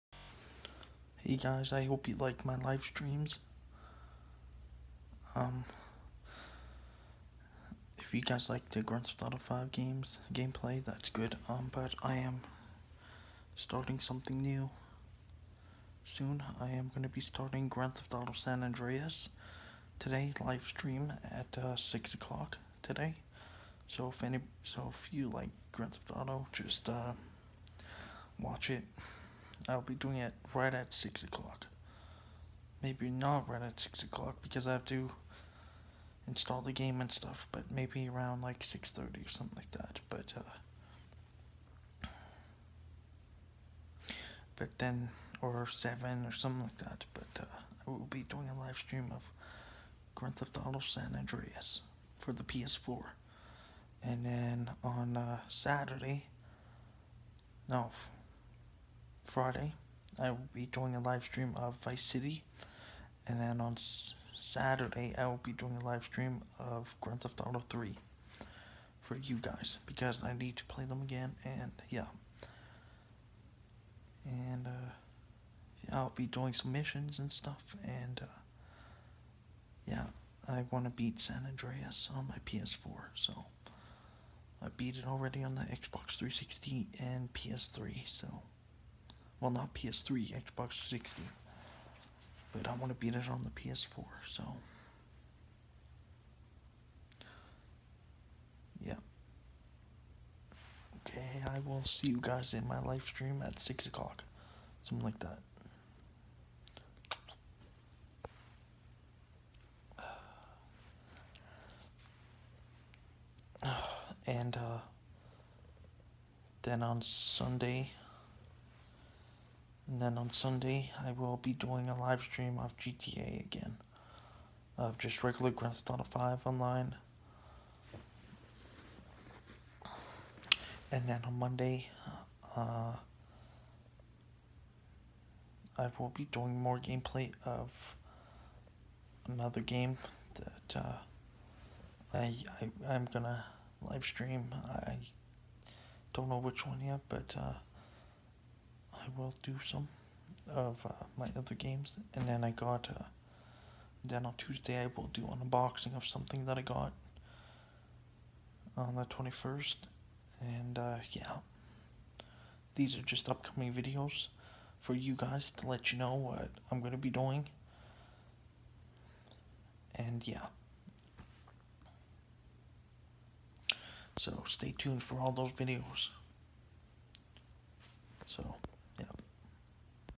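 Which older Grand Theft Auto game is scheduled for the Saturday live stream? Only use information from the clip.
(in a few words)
Grand Theft Auto 3.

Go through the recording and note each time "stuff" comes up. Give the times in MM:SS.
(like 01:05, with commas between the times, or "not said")
00:37, 01:17.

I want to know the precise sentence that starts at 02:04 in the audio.
Of just regular Grand Theft Auto 5 online.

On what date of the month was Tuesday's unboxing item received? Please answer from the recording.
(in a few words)
21st.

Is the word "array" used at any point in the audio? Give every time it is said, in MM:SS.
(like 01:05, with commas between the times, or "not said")
not said.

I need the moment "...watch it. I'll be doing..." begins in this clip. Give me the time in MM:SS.
00:28.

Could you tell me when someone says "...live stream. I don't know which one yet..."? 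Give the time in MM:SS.
02:23.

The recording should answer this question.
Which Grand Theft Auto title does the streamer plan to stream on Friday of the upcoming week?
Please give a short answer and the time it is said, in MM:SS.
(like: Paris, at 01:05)
Vice City, at 01:01.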